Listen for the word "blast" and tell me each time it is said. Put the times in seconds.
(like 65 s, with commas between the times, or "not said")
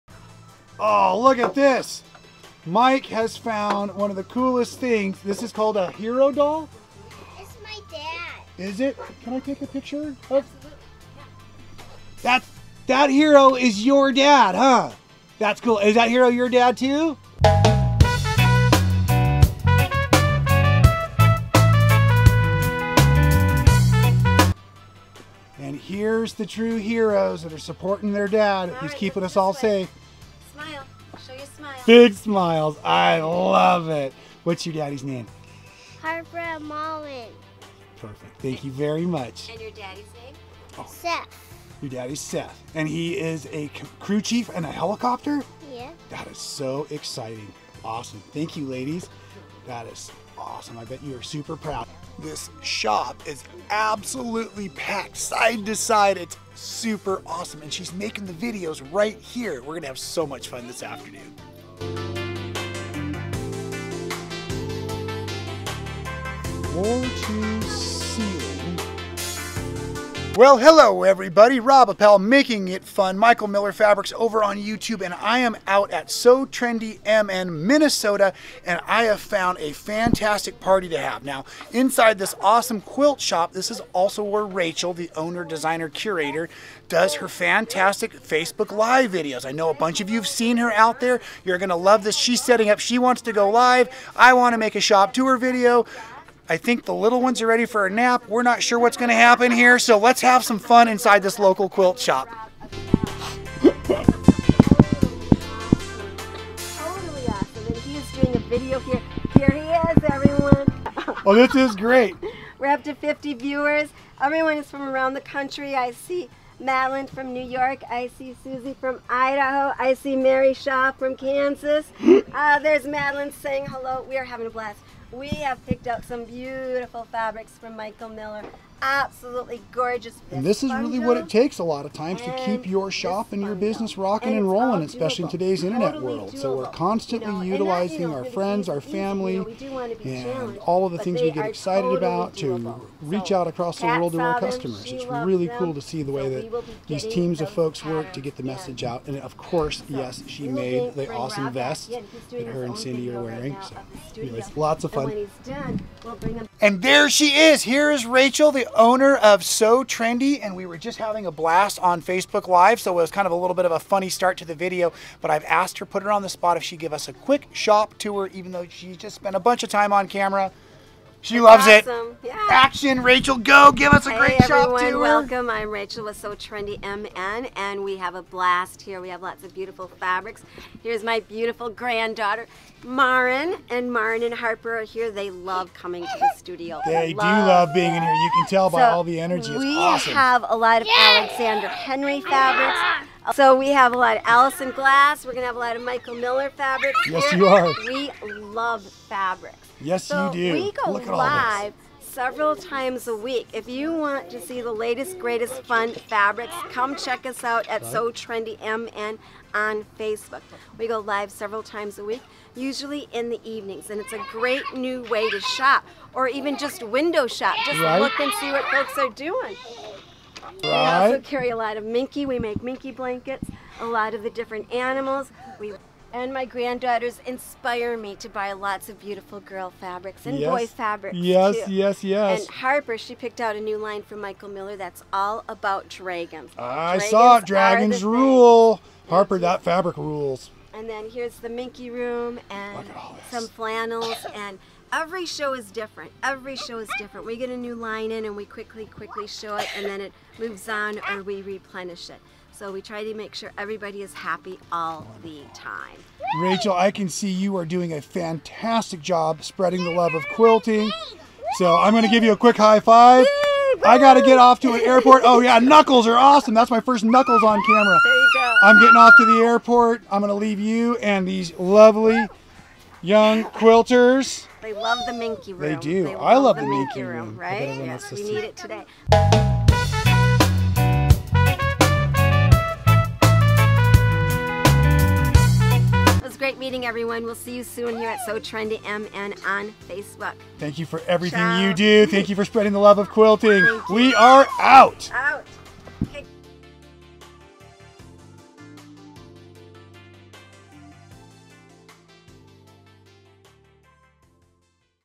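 124 s, 161 s, 178 s.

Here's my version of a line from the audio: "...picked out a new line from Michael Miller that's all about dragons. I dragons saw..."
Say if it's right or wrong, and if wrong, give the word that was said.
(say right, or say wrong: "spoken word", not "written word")
right.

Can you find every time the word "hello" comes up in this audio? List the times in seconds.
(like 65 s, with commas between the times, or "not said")
70 s, 123 s.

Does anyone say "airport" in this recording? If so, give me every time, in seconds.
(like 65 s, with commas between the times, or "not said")
264 s, 269 s.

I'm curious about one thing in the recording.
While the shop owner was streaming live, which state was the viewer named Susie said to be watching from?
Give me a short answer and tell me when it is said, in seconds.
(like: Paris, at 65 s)
Idaho, at 119 s.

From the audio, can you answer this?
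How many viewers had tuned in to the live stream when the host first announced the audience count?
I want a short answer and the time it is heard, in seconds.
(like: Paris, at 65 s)
50, at 112 s.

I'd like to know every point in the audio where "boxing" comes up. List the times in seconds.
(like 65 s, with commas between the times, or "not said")
not said.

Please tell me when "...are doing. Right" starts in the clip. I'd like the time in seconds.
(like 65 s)
218 s.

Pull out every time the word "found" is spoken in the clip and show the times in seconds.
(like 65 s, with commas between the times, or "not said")
3 s, 79 s.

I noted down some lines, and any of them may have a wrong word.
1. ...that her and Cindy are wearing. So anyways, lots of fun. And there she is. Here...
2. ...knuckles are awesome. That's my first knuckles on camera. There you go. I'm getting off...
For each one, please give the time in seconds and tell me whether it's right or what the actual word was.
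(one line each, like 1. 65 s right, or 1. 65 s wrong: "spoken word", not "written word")
1. 152 s right
2. 265 s right.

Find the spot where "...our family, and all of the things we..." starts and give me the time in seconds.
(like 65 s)
138 s.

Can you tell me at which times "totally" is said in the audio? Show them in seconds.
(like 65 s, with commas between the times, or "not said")
135 s, 141 s.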